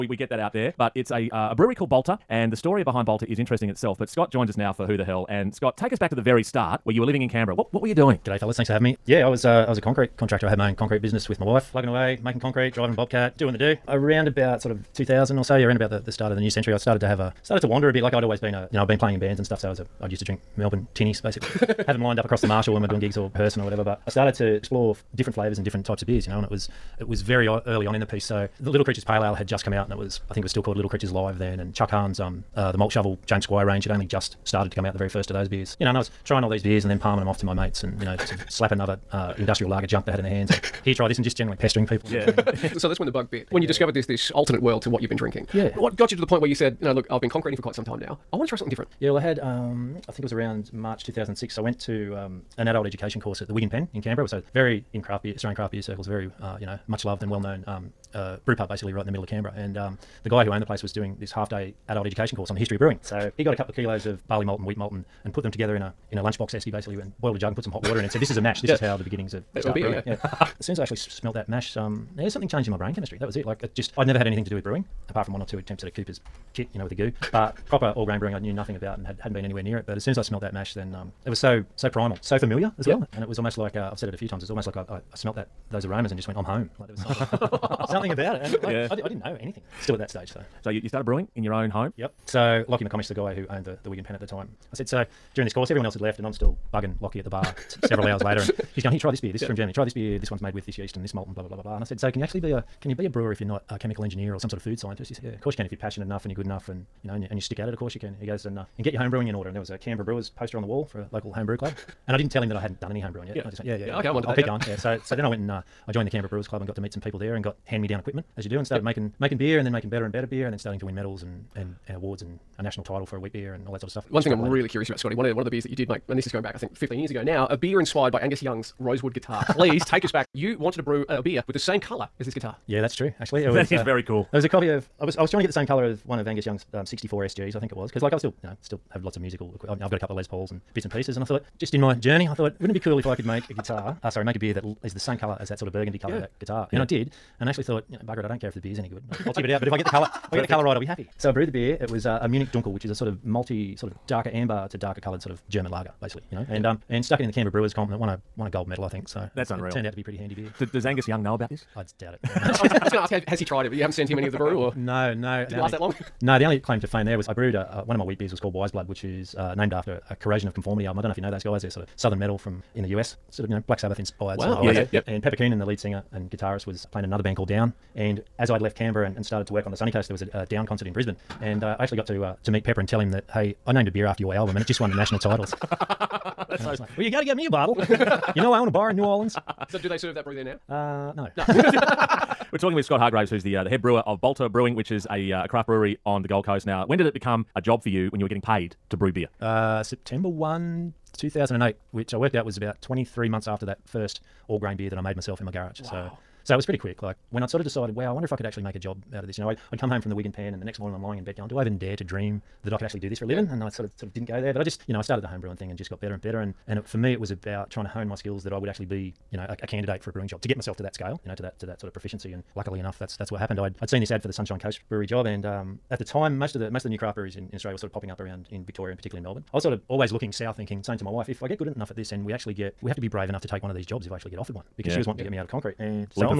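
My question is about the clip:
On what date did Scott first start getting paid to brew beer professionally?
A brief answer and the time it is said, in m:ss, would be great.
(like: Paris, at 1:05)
September 1, 2008, at 3:19.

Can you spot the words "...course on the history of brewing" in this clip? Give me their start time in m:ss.
1:02.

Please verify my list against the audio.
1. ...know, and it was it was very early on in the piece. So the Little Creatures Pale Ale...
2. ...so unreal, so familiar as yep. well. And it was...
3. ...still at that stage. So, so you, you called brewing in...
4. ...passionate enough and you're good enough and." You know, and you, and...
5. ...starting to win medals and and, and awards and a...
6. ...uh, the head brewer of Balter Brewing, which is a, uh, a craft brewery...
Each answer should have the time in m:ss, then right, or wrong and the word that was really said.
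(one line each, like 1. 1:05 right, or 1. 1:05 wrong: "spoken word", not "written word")
1. 0:26 right
2. 1:21 wrong: "primal", not "unreal"
3. 1:29 wrong: "started", not "called"
4. 1:45 right
5. 2:00 right
6. 3:13 right.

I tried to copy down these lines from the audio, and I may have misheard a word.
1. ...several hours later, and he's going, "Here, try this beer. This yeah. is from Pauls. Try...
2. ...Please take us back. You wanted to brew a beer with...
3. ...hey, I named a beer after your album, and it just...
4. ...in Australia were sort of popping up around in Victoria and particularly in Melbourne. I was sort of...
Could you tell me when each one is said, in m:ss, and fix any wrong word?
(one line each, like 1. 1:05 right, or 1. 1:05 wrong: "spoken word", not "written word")
1. 1:37 wrong: "Germany", not "Pauls"
2. 2:09 right
3. 3:03 right
4. 3:47 right.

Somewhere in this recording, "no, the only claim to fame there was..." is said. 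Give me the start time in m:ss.
2:46.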